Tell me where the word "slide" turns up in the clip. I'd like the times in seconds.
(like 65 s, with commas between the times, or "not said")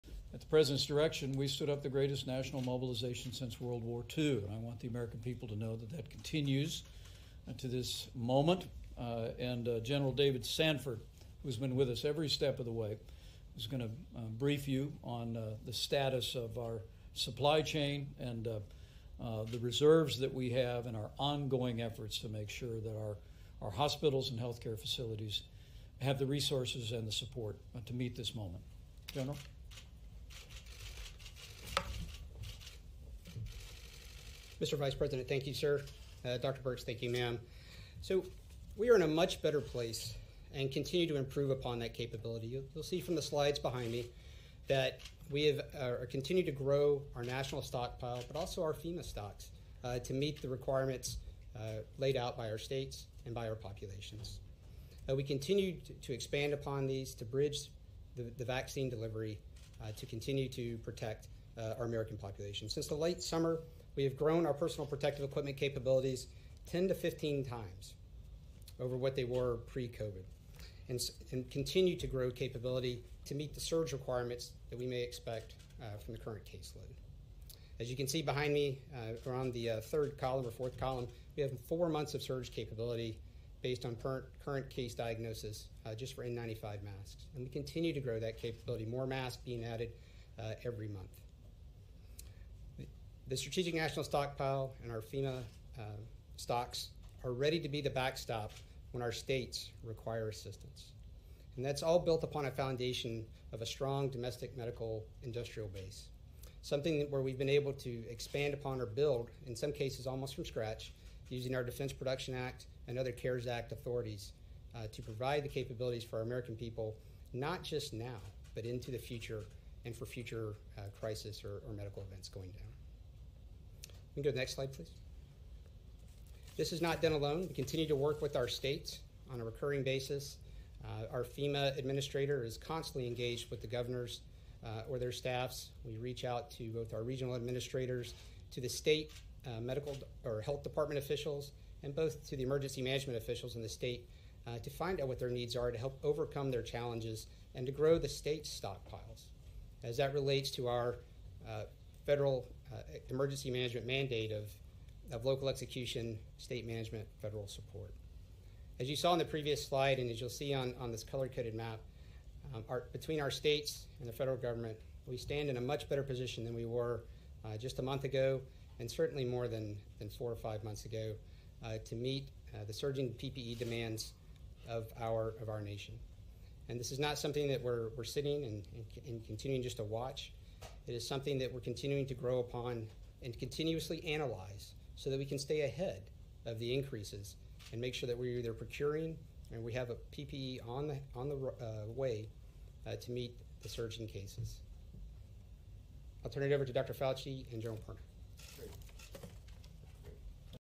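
43 s, 124 s, 159 s.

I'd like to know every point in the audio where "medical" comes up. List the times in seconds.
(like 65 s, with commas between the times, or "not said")
104 s, 121 s, 139 s.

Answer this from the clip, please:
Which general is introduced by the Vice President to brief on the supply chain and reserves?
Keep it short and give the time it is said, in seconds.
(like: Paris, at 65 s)
David Sanford, at 10 s.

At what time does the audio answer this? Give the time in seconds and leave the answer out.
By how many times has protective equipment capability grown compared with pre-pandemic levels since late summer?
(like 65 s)
66 s.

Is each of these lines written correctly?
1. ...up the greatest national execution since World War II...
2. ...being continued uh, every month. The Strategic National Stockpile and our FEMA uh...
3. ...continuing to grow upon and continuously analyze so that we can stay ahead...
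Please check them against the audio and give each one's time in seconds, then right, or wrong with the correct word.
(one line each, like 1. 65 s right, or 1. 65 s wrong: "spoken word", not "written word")
1. 1 s wrong: "mobilization", not "execution"
2. 89 s wrong: "added", not "continued"
3. 181 s right.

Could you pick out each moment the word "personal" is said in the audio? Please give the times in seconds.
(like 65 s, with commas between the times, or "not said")
64 s.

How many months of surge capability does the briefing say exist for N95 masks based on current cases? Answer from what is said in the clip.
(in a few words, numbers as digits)
4 months.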